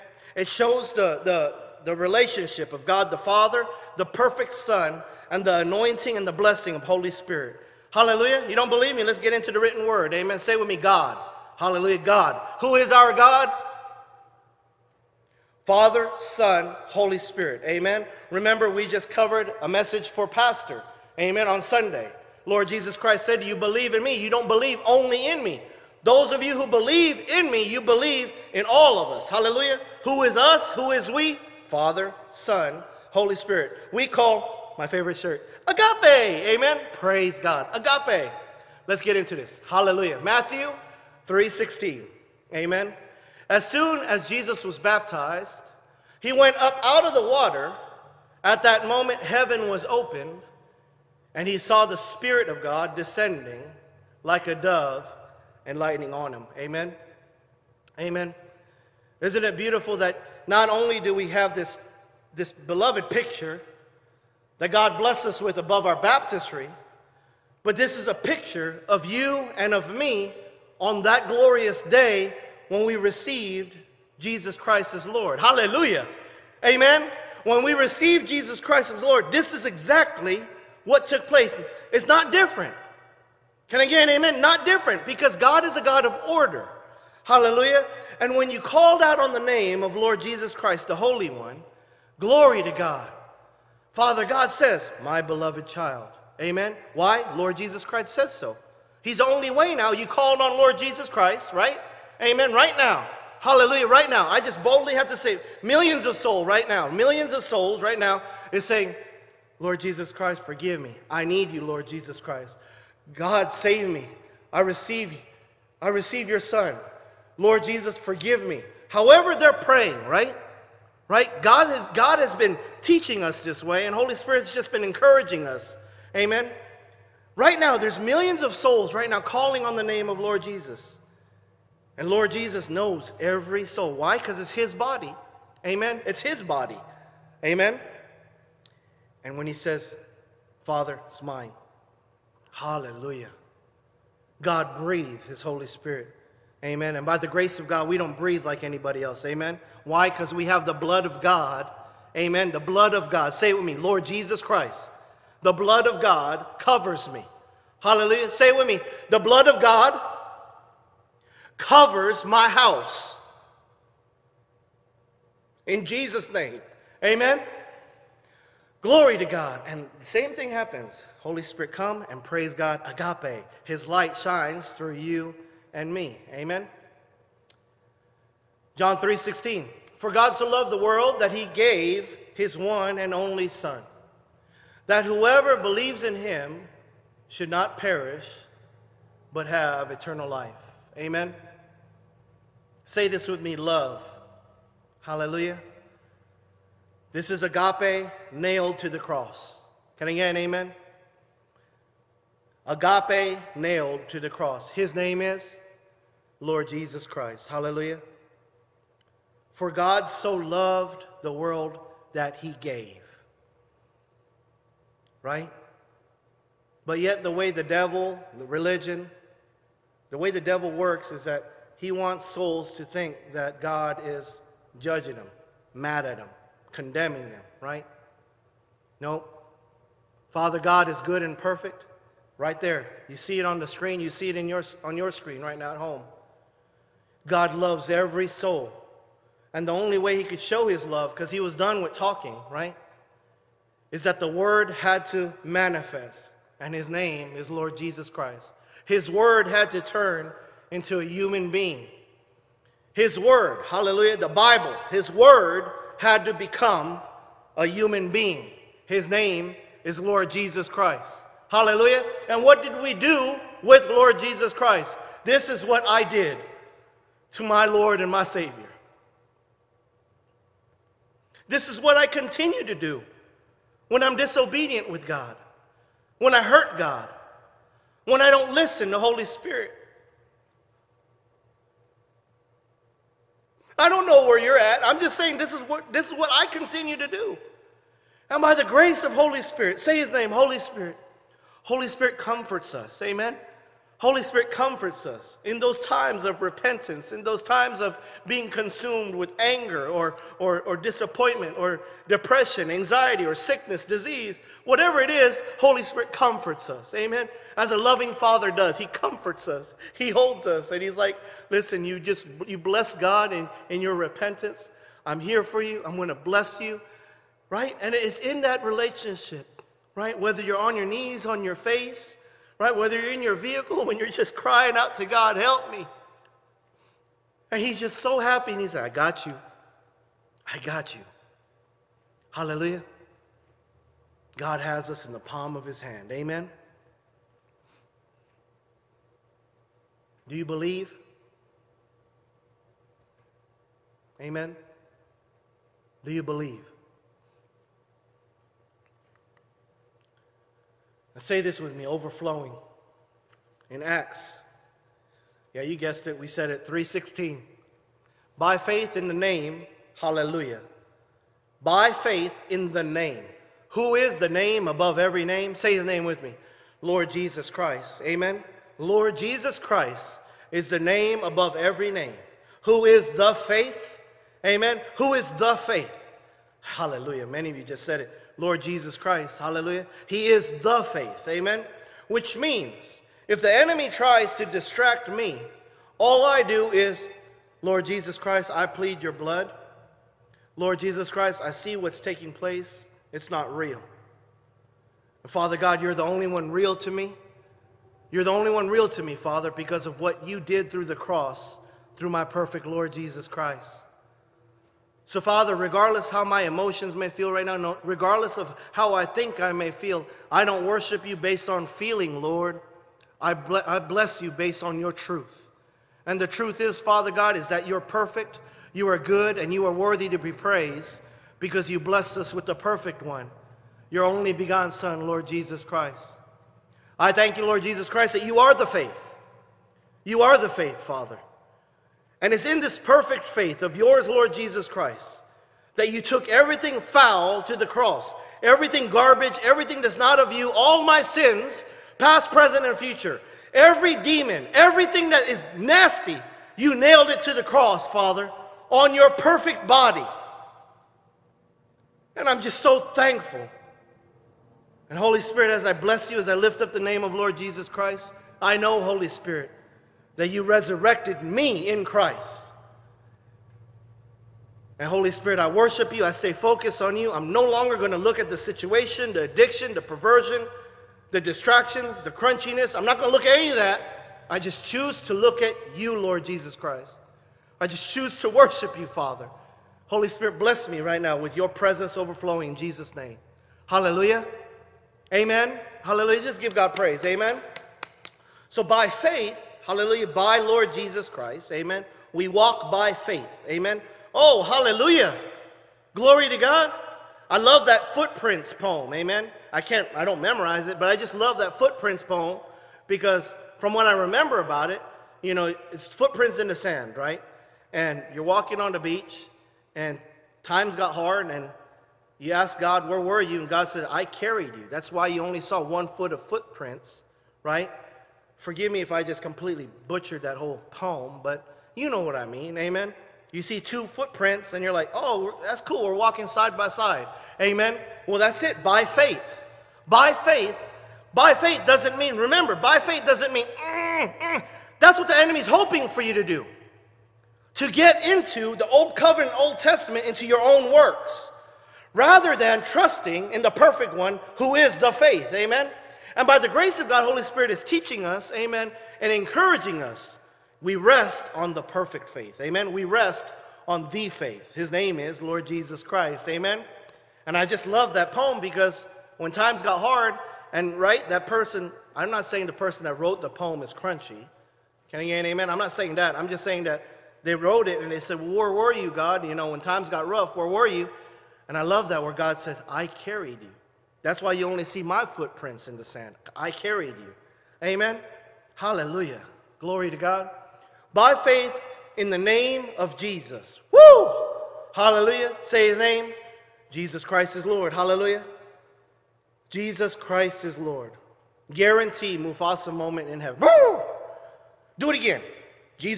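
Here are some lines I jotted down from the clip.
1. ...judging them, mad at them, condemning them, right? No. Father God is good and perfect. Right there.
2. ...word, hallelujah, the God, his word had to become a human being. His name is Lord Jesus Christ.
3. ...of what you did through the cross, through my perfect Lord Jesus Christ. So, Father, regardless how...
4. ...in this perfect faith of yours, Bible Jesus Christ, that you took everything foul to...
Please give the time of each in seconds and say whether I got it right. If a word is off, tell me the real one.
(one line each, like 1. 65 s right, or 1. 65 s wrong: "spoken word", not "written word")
1. 224 s right
2. 253 s wrong: "Bible", not "God"
3. 399 s right
4. 432 s wrong: "Lord", not "Bible".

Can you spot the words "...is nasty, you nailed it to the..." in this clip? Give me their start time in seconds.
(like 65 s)
445 s.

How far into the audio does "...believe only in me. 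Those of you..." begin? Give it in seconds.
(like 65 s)
24 s.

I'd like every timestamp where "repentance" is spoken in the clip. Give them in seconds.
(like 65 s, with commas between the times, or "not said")
296 s, 313 s.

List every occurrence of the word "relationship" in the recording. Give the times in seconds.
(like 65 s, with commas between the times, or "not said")
1 s, 318 s.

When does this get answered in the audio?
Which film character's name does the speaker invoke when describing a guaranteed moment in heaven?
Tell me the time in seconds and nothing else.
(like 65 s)
592 s.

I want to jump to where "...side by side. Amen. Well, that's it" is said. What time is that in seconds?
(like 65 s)
526 s.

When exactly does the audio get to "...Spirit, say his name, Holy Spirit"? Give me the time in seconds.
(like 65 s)
289 s.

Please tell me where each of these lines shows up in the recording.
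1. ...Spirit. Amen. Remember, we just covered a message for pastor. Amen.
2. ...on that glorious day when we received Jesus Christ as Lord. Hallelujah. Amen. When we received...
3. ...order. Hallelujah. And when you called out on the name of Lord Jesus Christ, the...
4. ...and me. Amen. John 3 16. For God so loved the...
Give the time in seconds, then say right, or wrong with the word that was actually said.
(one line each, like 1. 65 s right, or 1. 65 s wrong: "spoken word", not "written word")
1. 17 s right
2. 70 s right
3. 86 s right
4. 175 s right.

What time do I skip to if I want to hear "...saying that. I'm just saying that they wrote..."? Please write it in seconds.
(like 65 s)
565 s.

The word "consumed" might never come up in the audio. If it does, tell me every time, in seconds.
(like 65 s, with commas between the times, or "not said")
298 s.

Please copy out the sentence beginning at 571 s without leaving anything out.
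And I love that where God said, I carried you.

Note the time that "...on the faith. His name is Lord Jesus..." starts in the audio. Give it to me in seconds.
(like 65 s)
553 s.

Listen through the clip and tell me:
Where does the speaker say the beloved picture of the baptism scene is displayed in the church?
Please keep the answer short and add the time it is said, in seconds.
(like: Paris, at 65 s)
above our baptistry, at 65 s.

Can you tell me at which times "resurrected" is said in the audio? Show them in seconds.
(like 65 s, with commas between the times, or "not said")
460 s.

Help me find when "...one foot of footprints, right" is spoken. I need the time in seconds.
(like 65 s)
515 s.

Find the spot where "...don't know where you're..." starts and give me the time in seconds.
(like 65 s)
283 s.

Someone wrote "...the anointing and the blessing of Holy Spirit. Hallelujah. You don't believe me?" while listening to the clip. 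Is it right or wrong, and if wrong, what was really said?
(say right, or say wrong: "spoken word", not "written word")
right.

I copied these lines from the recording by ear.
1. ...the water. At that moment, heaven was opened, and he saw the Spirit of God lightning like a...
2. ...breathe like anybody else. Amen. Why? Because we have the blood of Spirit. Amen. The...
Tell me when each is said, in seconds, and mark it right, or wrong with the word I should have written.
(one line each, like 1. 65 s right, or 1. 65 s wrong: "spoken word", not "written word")
1. 47 s wrong: "descending", not "lightning"
2. 148 s wrong: "God", not "Spirit".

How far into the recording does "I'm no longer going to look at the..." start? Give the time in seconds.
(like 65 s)
467 s.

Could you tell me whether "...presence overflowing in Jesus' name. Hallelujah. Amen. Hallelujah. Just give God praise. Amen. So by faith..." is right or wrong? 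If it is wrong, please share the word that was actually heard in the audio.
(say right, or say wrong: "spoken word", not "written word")
right.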